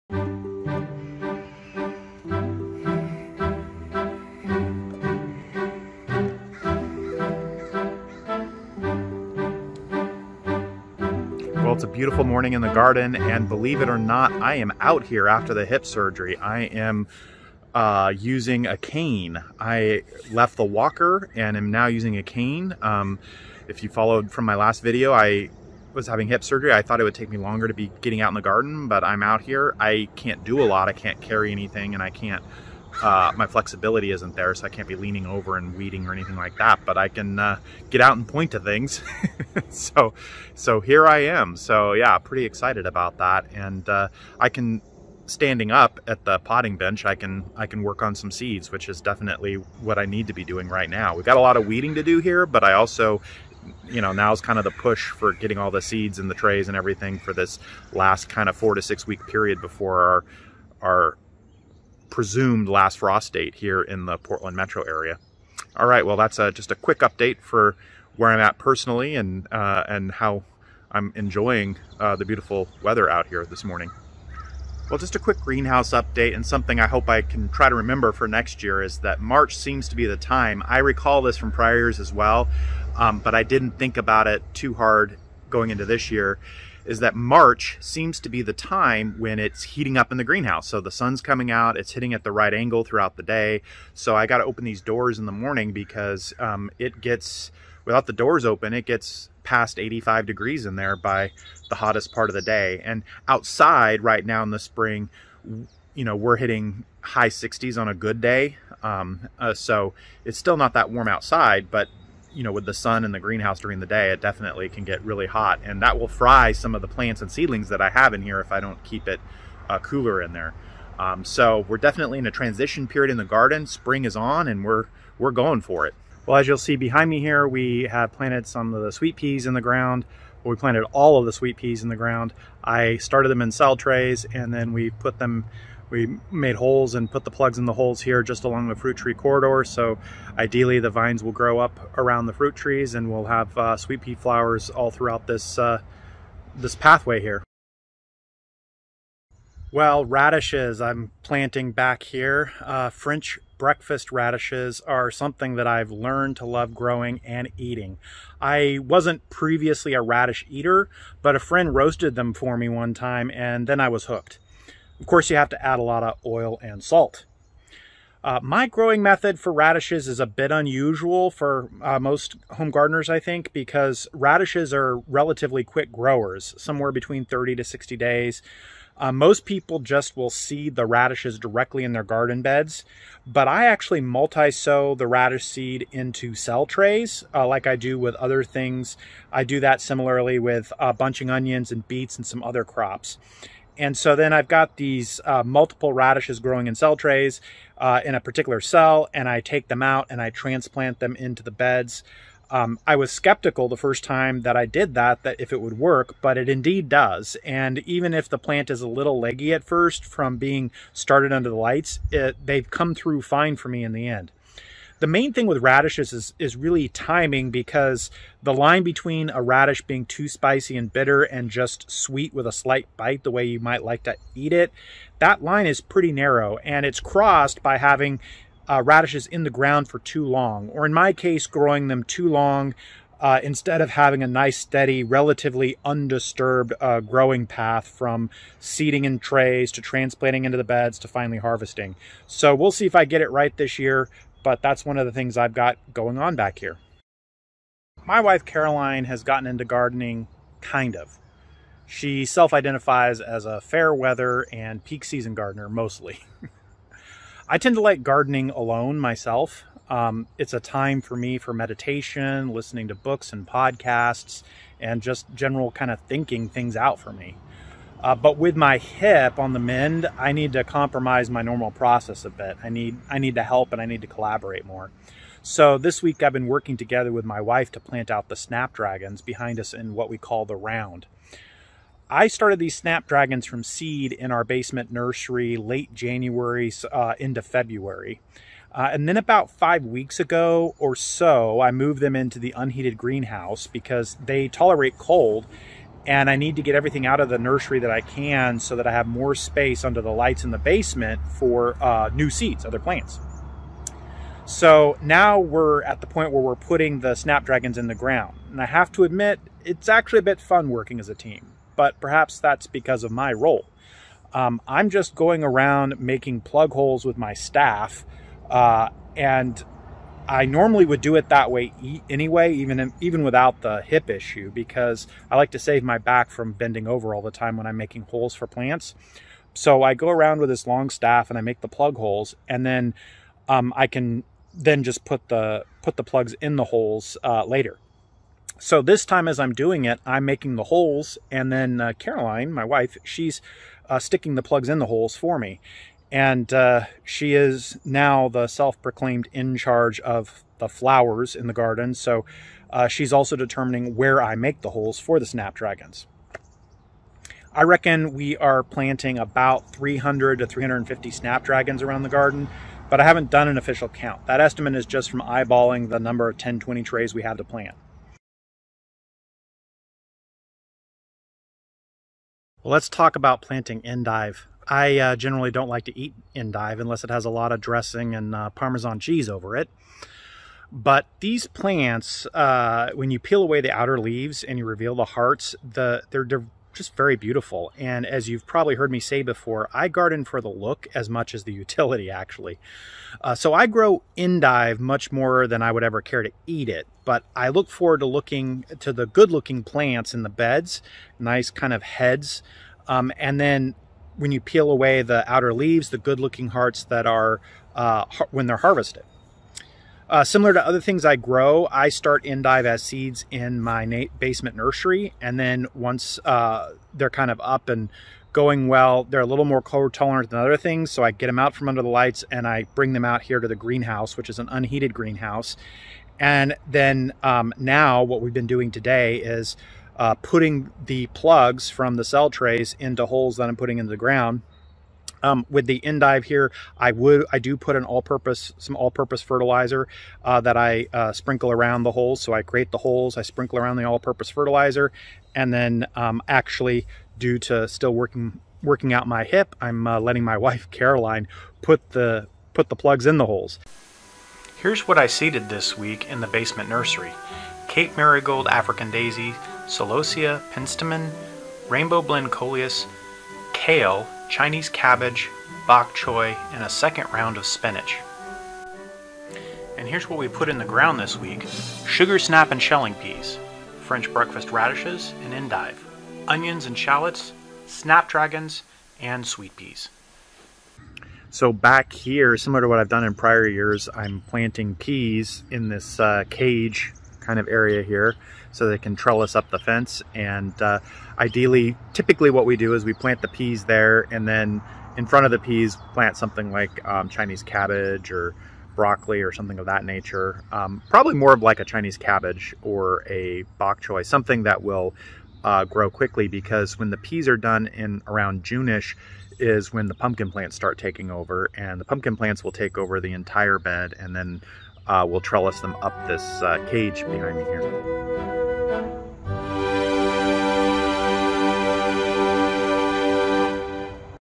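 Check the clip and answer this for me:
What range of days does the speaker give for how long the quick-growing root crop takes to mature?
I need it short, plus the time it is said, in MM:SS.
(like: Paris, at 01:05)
30 to 60 days, at 02:57.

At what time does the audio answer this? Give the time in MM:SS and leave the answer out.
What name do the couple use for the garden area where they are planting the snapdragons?
04:40.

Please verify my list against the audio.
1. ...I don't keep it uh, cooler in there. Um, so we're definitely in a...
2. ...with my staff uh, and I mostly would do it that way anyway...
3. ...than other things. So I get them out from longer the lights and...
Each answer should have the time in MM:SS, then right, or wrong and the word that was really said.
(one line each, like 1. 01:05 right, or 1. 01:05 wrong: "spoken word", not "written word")
1. 01:58 right
2. 05:17 wrong: "normally", not "mostly"
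3. 07:00 wrong: "under", not "longer".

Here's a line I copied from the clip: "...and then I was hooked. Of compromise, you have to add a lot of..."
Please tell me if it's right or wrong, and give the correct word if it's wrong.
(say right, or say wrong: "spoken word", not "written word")
wrong: "course", not "compromise".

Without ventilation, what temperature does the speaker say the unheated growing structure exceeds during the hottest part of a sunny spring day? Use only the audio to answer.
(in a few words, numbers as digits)
85 degrees.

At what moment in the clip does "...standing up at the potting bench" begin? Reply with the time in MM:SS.
00:45.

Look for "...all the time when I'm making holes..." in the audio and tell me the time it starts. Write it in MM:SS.
05:27.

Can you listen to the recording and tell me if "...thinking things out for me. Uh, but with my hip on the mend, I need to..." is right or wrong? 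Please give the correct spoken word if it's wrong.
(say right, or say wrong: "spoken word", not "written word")
right.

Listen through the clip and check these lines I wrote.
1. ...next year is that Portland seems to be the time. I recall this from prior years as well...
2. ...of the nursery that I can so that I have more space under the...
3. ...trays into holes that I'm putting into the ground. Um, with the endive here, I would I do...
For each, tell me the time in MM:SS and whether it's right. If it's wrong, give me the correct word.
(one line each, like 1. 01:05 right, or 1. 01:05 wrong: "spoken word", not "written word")
1. 01:18 wrong: "March", not "Portland"
2. 04:57 right
3. 07:12 right.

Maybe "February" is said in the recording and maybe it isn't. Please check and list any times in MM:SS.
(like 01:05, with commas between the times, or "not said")
04:47.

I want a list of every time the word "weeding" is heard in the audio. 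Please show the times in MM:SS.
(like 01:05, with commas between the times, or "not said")
00:35, 00:51.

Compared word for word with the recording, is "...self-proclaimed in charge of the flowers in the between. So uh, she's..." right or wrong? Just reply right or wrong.
wrong.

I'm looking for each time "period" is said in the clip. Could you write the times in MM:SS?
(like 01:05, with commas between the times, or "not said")
00:59, 02:02.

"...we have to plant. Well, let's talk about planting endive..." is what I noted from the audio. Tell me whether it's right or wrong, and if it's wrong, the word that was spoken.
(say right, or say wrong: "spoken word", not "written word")
right.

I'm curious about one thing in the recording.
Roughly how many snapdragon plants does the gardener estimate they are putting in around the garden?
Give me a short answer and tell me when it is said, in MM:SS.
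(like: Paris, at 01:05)
300 to 350, at 05:59.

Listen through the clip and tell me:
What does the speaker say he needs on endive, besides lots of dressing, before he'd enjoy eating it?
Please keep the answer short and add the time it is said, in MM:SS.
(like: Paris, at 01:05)
Parmesan cheese, at 06:18.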